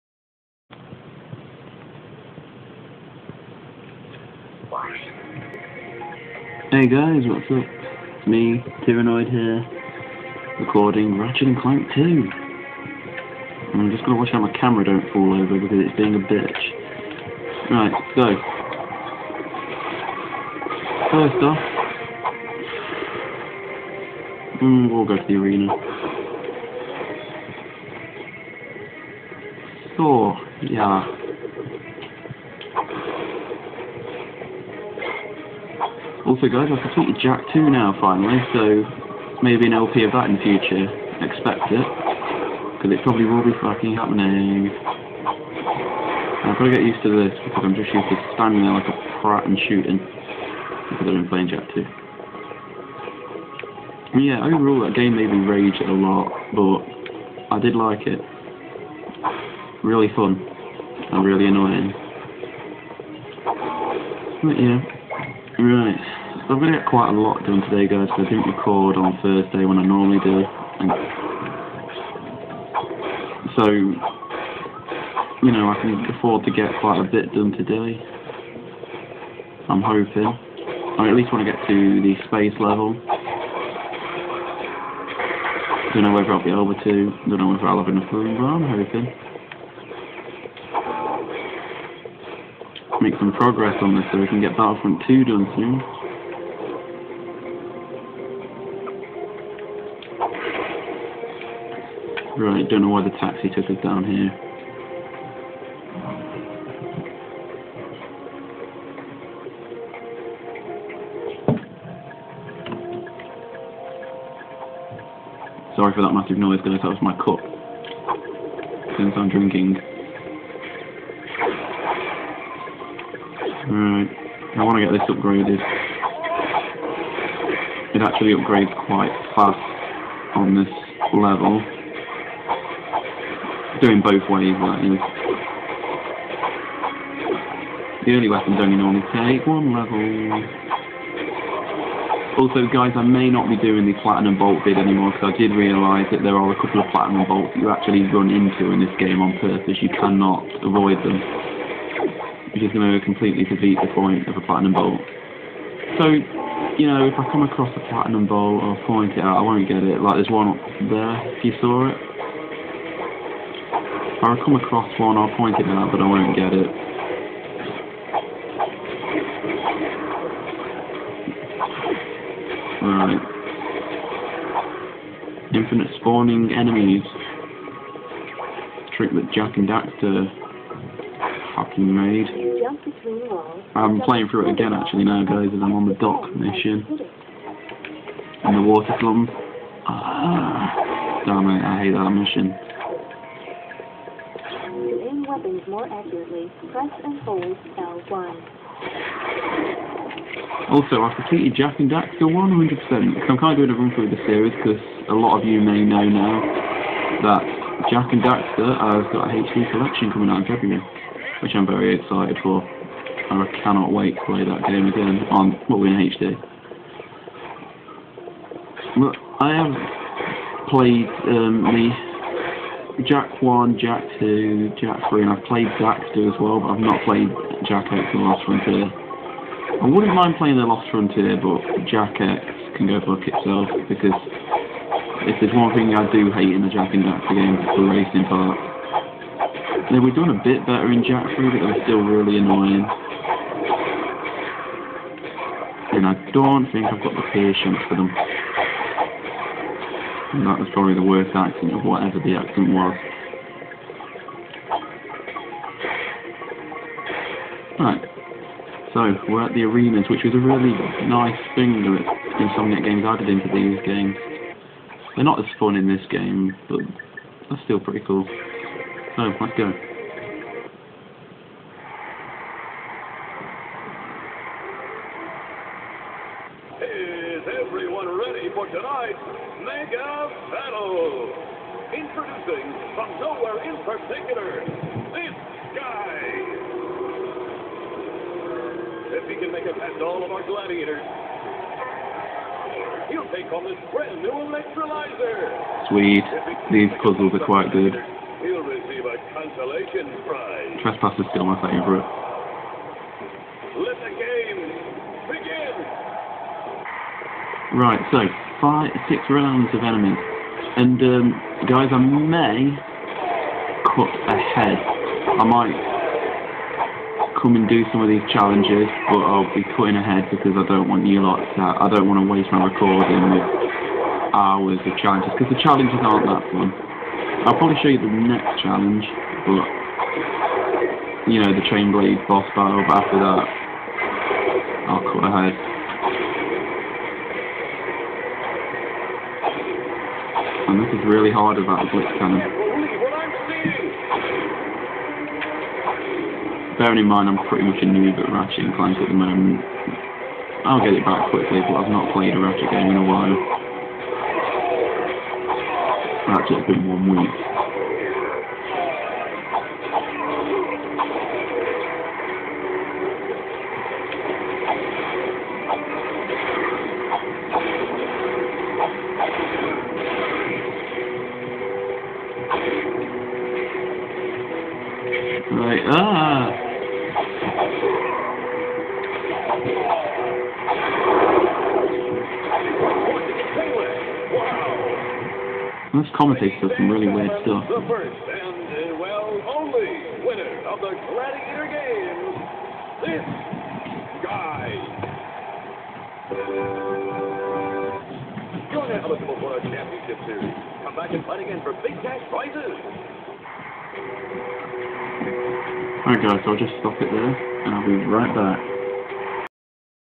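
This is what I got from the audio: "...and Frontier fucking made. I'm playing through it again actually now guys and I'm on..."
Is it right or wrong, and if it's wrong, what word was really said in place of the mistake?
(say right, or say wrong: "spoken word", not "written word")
wrong: "Daxter", not "Frontier".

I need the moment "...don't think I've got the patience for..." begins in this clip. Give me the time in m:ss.
4:06.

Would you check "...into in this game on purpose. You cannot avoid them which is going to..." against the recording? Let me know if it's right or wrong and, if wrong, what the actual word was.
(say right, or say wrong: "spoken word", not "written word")
right.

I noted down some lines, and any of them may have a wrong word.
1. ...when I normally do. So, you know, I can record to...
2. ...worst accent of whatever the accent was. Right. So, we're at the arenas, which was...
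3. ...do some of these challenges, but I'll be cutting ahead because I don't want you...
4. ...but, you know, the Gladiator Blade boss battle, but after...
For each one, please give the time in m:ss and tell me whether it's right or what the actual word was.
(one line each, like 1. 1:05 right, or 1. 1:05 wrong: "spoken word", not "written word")
1. 1:09 wrong: "afford", not "record"
2. 4:11 right
3. 5:17 right
4. 5:29 wrong: "Chain", not "Gladiator".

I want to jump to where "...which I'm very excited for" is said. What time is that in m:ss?
3:31.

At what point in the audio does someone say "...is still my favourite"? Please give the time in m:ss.
5:01.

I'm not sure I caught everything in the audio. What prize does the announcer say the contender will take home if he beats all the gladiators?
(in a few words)
electrolyzer.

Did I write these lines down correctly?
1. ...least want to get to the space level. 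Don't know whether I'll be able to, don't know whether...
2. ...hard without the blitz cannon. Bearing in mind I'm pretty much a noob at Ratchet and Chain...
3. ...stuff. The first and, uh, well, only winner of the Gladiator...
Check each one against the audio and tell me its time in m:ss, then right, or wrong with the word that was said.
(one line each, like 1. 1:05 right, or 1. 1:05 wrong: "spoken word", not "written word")
1. 1:21 right
2. 5:41 wrong: "Clank", not "Chain"
3. 6:27 right.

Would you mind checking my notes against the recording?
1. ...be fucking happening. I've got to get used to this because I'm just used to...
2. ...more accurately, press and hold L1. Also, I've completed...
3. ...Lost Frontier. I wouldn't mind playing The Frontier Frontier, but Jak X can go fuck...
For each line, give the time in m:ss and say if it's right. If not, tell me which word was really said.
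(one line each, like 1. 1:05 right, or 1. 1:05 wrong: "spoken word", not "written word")
1. 0:43 right
2. 3:15 right
3. 3:48 wrong: "Lost", not "Frontier".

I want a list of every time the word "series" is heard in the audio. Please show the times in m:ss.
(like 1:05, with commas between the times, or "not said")
3:24, 6:40.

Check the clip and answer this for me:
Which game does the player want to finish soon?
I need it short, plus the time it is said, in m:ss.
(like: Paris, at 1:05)
Battlefront 2, at 1:34.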